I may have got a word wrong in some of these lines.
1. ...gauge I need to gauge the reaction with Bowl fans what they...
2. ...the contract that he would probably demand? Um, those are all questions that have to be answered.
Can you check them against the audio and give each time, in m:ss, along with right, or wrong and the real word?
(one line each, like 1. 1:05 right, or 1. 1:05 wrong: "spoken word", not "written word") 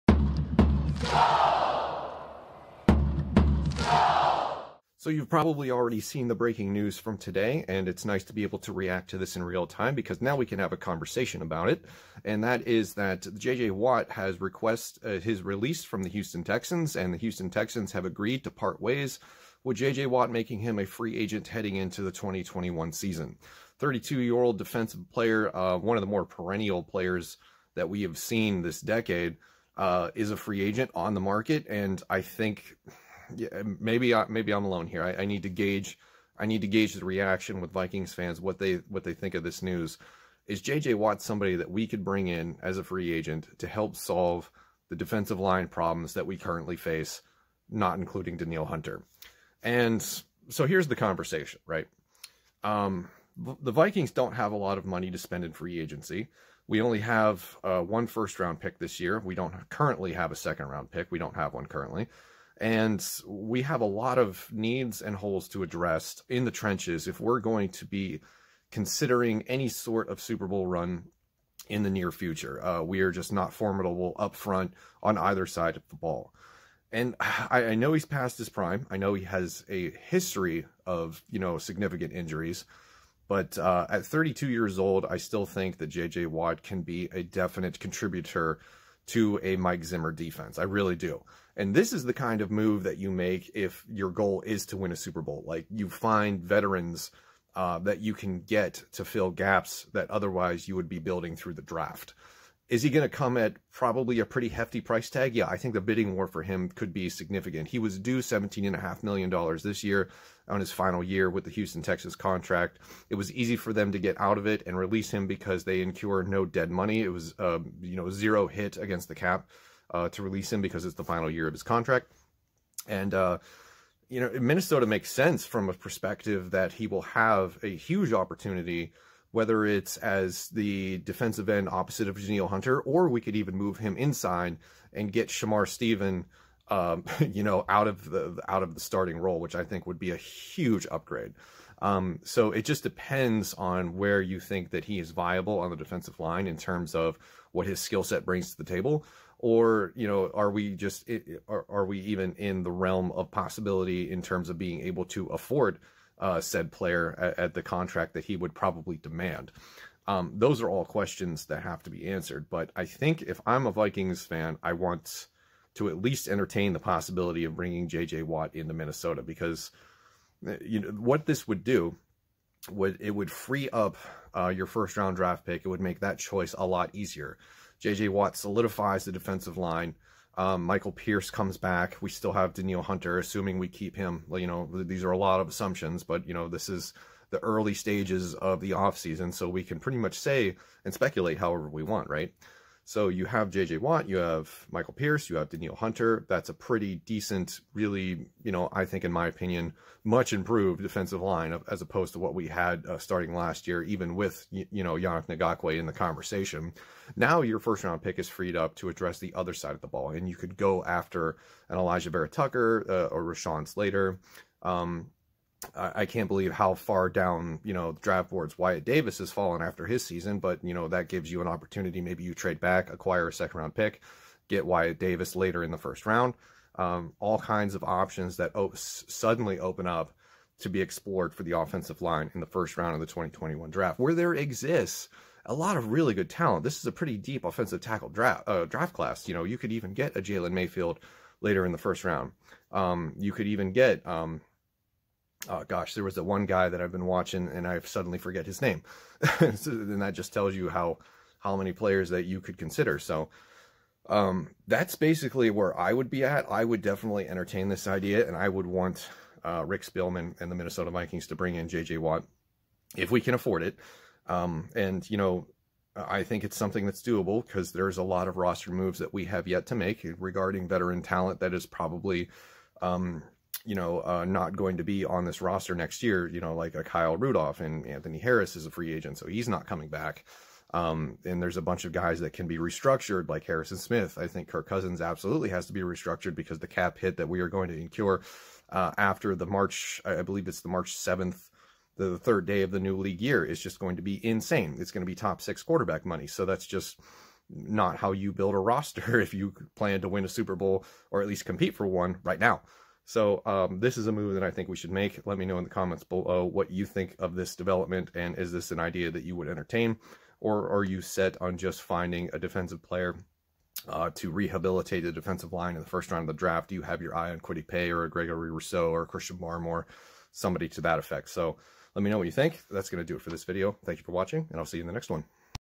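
1. 0:35 wrong: "Vikings", not "Bowl"
2. 2:37 right.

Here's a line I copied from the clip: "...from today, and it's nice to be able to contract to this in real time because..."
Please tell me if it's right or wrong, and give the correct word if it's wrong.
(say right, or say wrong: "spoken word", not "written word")
wrong: "react", not "contract".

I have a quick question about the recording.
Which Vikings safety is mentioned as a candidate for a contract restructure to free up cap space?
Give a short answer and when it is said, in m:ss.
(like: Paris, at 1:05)
Harrison Smith, at 4:43.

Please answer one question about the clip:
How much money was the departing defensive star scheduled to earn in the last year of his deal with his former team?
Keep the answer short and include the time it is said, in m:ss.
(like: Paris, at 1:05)
$17.5 million, at 1:48.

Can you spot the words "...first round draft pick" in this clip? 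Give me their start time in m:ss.
2:54.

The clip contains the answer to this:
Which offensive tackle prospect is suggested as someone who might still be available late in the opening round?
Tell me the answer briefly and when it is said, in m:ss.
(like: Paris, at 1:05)
Jalen Mayfield, at 4:00.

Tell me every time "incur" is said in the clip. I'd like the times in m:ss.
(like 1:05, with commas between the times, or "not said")
1:55, 4:47.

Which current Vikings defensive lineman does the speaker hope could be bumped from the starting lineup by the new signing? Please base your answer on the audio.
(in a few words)
Shamar Stephen.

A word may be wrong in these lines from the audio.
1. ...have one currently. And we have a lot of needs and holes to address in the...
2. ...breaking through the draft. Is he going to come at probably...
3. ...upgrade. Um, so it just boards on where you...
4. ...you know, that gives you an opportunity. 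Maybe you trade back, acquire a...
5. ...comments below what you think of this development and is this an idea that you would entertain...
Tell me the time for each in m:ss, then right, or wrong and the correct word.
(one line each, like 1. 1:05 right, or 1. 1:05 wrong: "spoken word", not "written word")
1. 1:01 right
2. 1:40 wrong: "building", not "breaking"
3. 2:20 wrong: "depends", not "boards"
4. 3:40 right
5. 5:05 right.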